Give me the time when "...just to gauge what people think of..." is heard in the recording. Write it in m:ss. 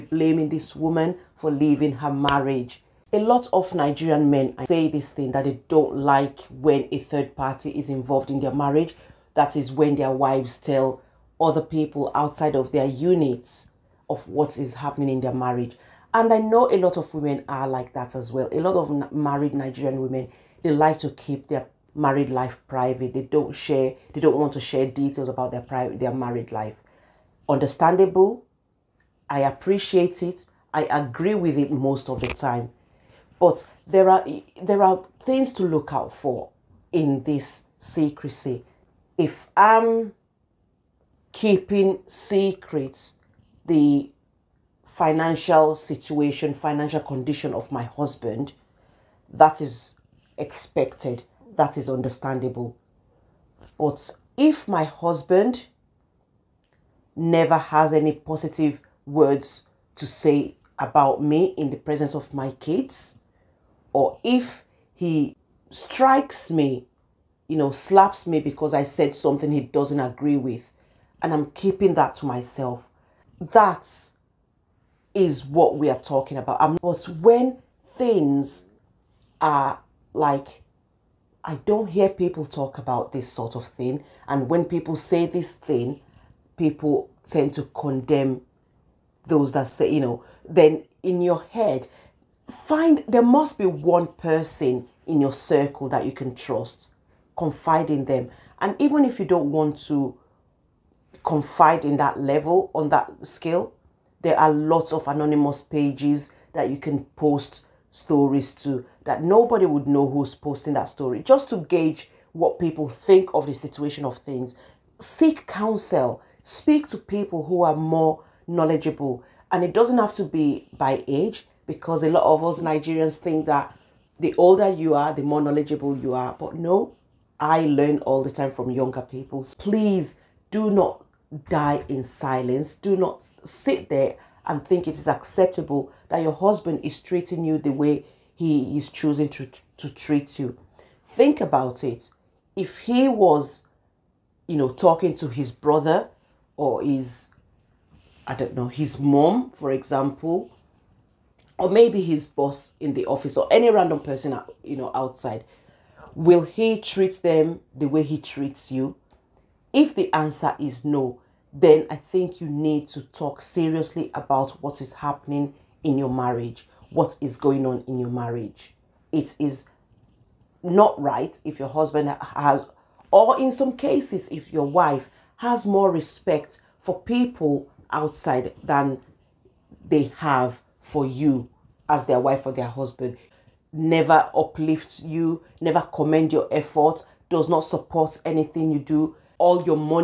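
1:51.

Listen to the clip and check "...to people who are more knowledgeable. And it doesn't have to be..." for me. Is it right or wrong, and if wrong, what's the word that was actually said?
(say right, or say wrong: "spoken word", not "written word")
right.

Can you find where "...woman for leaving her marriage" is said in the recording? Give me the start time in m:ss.
0:00.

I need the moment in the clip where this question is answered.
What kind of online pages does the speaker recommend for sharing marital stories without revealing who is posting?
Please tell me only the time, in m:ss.
1:45.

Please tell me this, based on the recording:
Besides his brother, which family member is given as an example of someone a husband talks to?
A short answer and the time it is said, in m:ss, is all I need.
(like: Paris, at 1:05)
His mom, at 2:28.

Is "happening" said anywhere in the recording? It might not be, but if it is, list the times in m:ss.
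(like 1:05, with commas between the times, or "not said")
0:14, 2:44.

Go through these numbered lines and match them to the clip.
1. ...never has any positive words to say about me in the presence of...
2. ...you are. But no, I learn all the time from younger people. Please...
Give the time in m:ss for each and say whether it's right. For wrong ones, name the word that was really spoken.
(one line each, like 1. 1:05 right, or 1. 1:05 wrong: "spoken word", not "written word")
1. 0:57 right
2. 2:05 right.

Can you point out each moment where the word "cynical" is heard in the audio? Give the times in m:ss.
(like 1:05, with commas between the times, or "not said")
not said.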